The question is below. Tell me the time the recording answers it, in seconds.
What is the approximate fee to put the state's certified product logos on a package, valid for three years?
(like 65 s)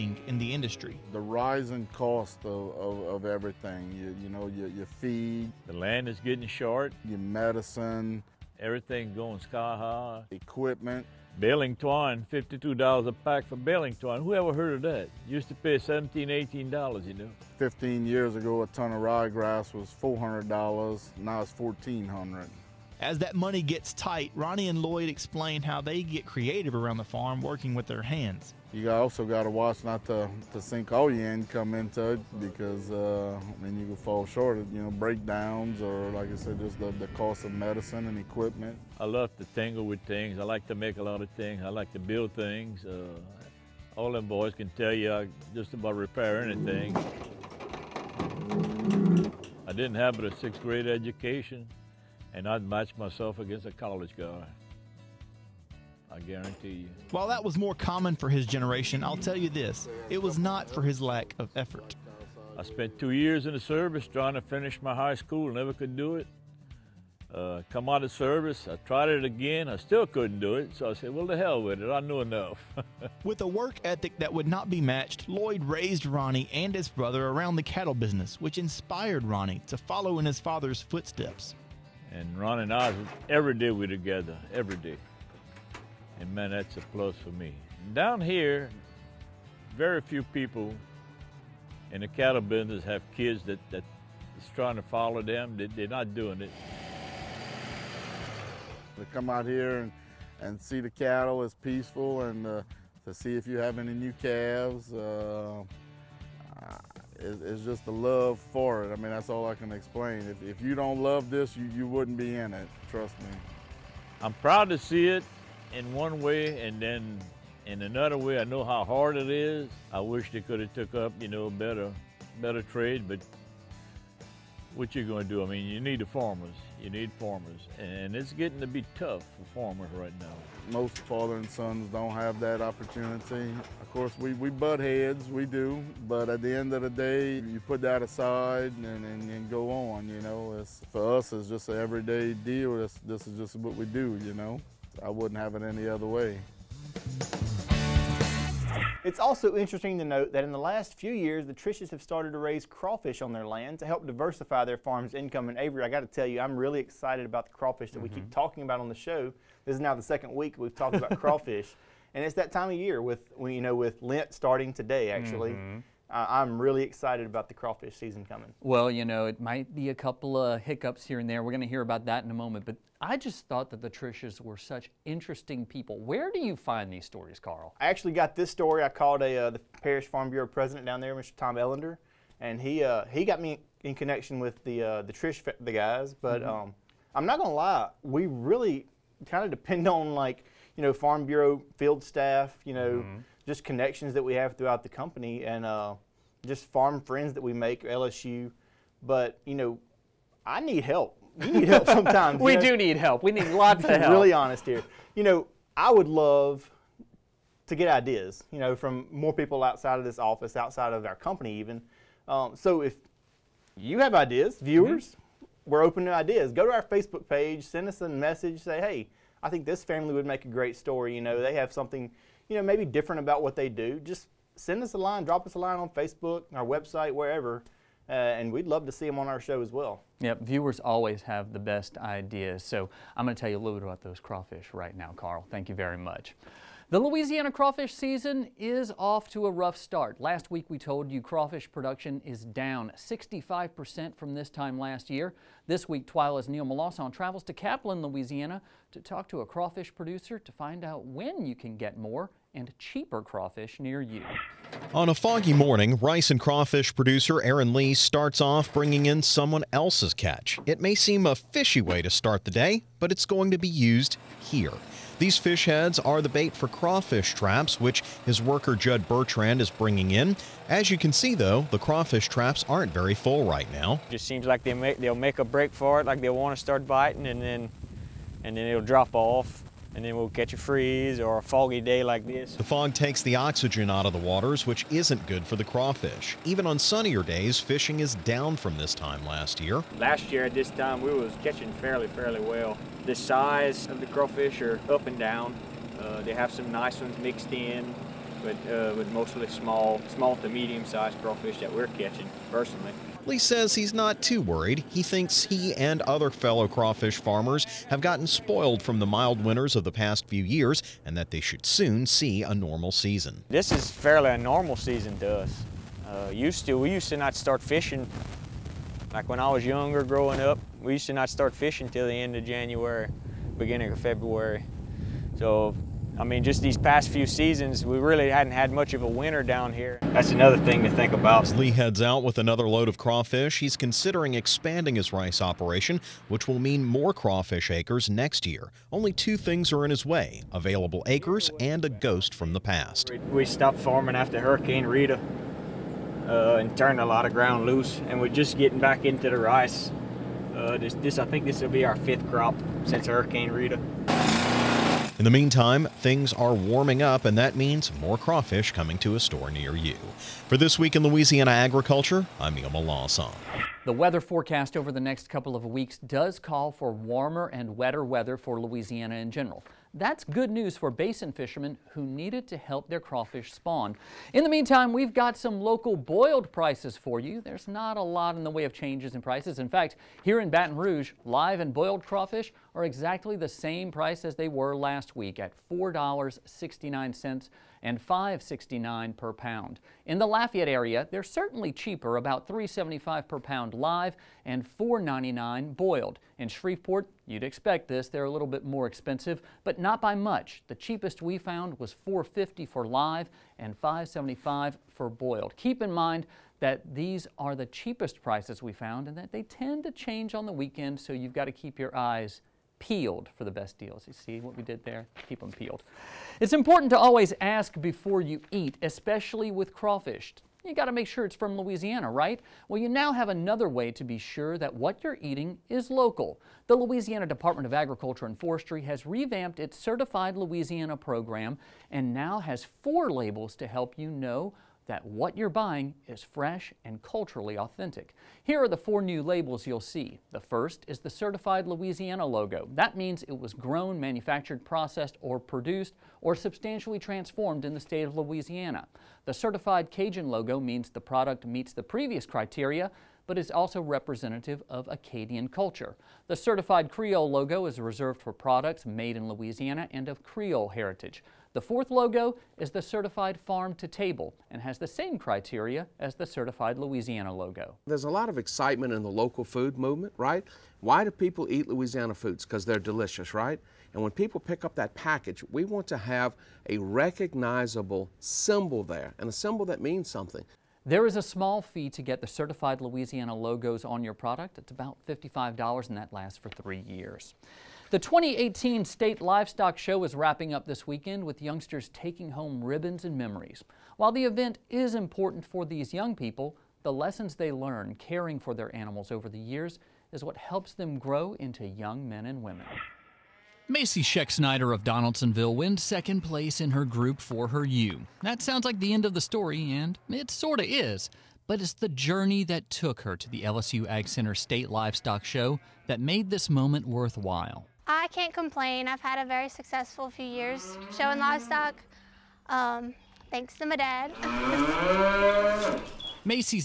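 485 s.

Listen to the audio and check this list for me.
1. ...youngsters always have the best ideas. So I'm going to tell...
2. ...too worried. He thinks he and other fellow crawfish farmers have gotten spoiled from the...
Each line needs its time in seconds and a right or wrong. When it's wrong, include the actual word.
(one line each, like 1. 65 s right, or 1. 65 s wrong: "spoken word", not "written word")
1. 230 s wrong: "viewers", not "youngsters"
2. 304 s right.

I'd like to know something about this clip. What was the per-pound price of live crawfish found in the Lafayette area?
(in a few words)
$3.75.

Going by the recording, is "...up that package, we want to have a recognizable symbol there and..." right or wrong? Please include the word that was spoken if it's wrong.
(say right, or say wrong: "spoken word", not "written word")
right.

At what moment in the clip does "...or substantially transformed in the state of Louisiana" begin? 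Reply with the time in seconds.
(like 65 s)
446 s.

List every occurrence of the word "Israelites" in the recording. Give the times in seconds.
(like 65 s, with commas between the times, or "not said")
not said.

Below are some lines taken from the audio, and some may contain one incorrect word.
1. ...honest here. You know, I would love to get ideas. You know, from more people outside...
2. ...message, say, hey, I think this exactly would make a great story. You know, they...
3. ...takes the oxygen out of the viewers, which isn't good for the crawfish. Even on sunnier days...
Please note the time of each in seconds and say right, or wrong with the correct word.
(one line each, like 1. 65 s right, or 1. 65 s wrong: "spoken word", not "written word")
1. 204 s right
2. 218 s wrong: "family", not "exactly"
3. 282 s wrong: "waters", not "viewers".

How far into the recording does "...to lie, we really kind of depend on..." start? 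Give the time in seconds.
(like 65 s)
187 s.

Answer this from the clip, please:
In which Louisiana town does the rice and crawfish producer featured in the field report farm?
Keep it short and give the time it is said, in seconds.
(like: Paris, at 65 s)
Kaplan, at 247 s.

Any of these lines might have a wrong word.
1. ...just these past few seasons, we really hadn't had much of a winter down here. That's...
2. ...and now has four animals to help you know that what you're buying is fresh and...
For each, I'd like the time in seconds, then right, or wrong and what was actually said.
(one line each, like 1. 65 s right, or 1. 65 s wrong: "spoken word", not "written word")
1. 326 s right
2. 431 s wrong: "labels", not "animals".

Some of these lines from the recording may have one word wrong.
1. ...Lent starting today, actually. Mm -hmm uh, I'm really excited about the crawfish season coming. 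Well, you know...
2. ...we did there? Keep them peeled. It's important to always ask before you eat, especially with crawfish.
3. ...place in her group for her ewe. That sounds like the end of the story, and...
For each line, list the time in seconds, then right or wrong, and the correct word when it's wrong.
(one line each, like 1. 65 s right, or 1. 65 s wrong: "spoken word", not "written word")
1. 164 s right
2. 414 s right
3. 506 s right.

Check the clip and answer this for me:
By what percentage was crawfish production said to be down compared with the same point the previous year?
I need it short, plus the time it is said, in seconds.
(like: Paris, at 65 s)
65%, at 242 s.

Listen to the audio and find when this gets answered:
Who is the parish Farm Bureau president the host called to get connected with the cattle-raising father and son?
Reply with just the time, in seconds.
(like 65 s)
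181 s.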